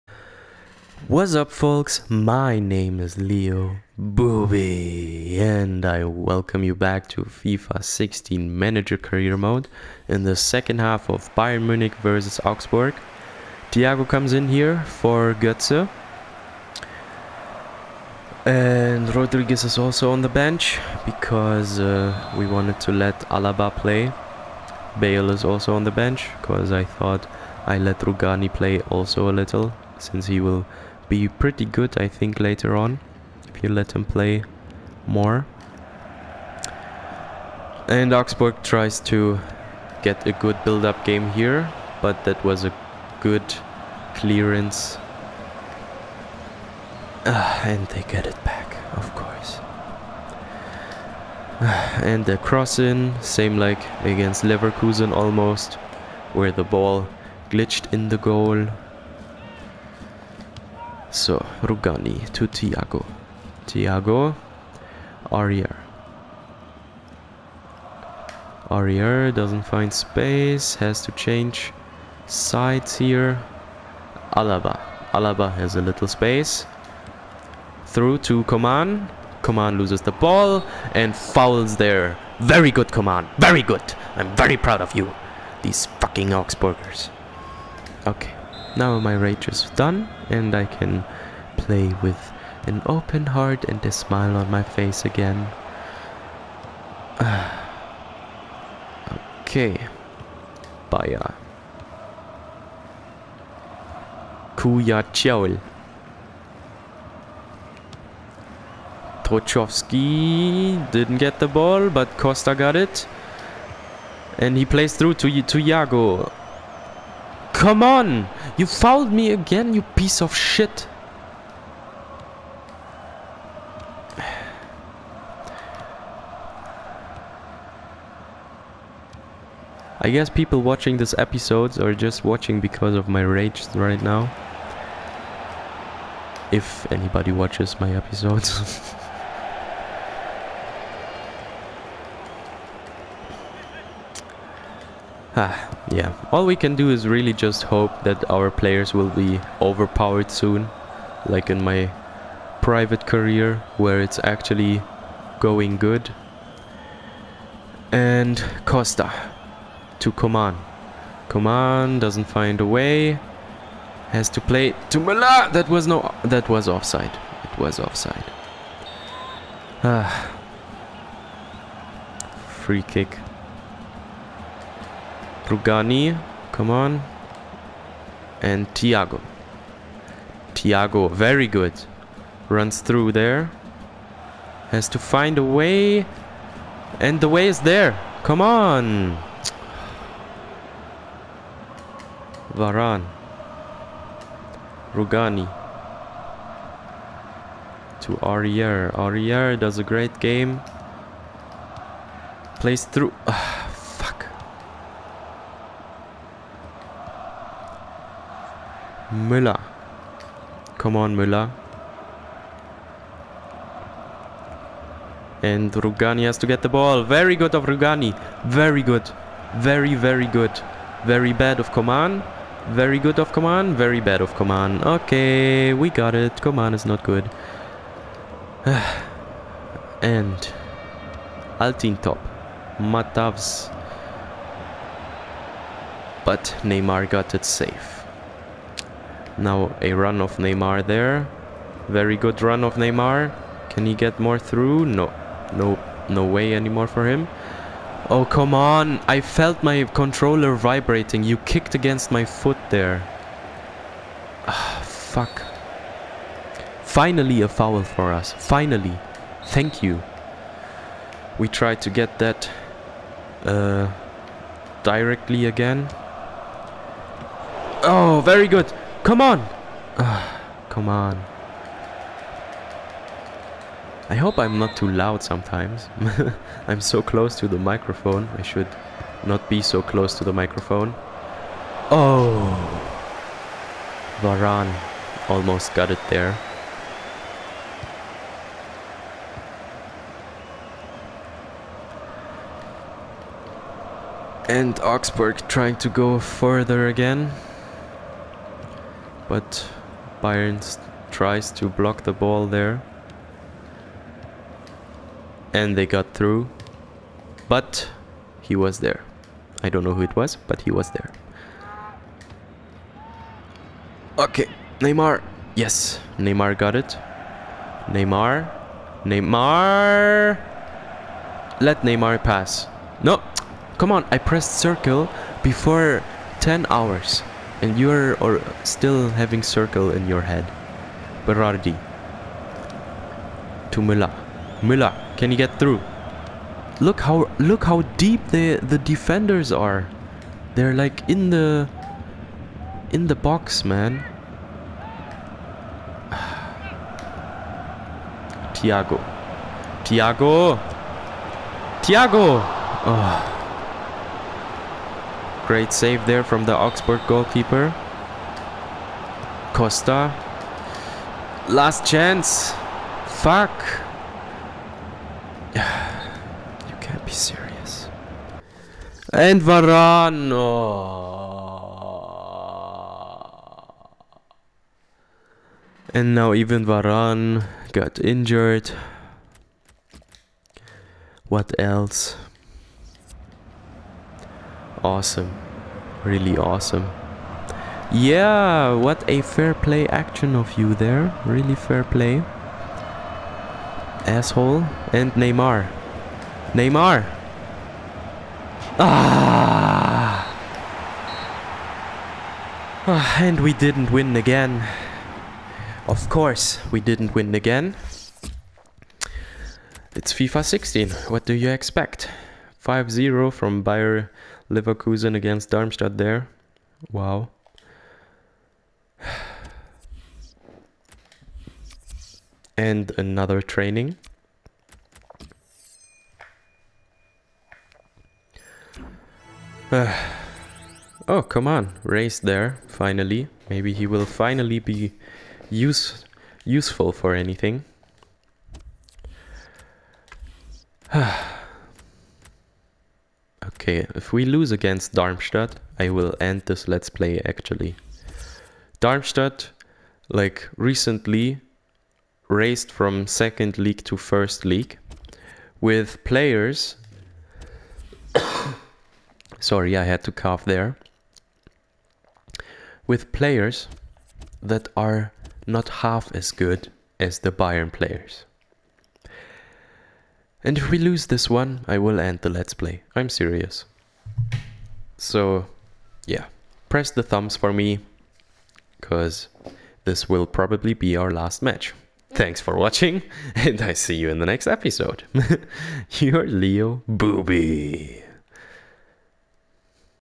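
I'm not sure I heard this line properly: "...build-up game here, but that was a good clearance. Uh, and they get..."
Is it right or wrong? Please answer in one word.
right.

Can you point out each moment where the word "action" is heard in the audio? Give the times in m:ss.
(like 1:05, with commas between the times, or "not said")
6:29.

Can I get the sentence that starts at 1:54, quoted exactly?
And he plays through to, to Yago.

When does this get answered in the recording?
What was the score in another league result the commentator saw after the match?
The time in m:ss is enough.
6:52.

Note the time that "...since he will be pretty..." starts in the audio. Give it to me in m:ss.
0:29.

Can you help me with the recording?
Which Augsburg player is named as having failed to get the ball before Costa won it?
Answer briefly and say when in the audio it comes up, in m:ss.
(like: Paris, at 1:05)
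Trochowski, at 1:49.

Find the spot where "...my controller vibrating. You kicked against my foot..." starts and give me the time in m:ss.
4:09.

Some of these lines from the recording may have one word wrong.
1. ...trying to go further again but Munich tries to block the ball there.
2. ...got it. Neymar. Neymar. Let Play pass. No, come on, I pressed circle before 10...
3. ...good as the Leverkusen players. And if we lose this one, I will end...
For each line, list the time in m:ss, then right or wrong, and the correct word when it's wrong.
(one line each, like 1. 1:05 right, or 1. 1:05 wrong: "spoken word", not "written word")
1. 4:55 wrong: "Bayern", not "Munich"
2. 5:16 wrong: "Neymar", not "Play"
3. 7:46 wrong: "Bayern", not "Leverkusen".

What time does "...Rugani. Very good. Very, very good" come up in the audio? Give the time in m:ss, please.
3:37.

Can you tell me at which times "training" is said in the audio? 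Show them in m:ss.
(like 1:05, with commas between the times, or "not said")
7:03.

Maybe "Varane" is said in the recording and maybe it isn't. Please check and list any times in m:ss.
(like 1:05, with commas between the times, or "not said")
3:12, 4:44, 6:09, 6:16.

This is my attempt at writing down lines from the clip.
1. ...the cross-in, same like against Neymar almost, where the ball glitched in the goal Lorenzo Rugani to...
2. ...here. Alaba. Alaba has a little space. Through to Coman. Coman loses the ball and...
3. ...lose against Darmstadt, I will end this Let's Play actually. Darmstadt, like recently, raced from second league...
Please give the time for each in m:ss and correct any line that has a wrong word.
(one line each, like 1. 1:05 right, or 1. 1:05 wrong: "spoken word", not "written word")
1. 0:52 wrong: "Leverkusen", not "Neymar"
2. 1:12 right
3. 7:24 right.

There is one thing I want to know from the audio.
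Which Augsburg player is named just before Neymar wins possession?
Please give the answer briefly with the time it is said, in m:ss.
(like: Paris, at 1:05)
Altintop, at 3:51.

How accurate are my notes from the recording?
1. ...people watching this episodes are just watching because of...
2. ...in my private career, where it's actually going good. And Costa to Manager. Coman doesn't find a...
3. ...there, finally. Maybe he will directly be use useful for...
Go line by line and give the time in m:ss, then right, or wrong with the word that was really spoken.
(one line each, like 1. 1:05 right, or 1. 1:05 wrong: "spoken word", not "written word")
1. 2:10 right
2. 2:31 wrong: "Coman", not "Manager"
3. 7:12 wrong: "finally", not "directly".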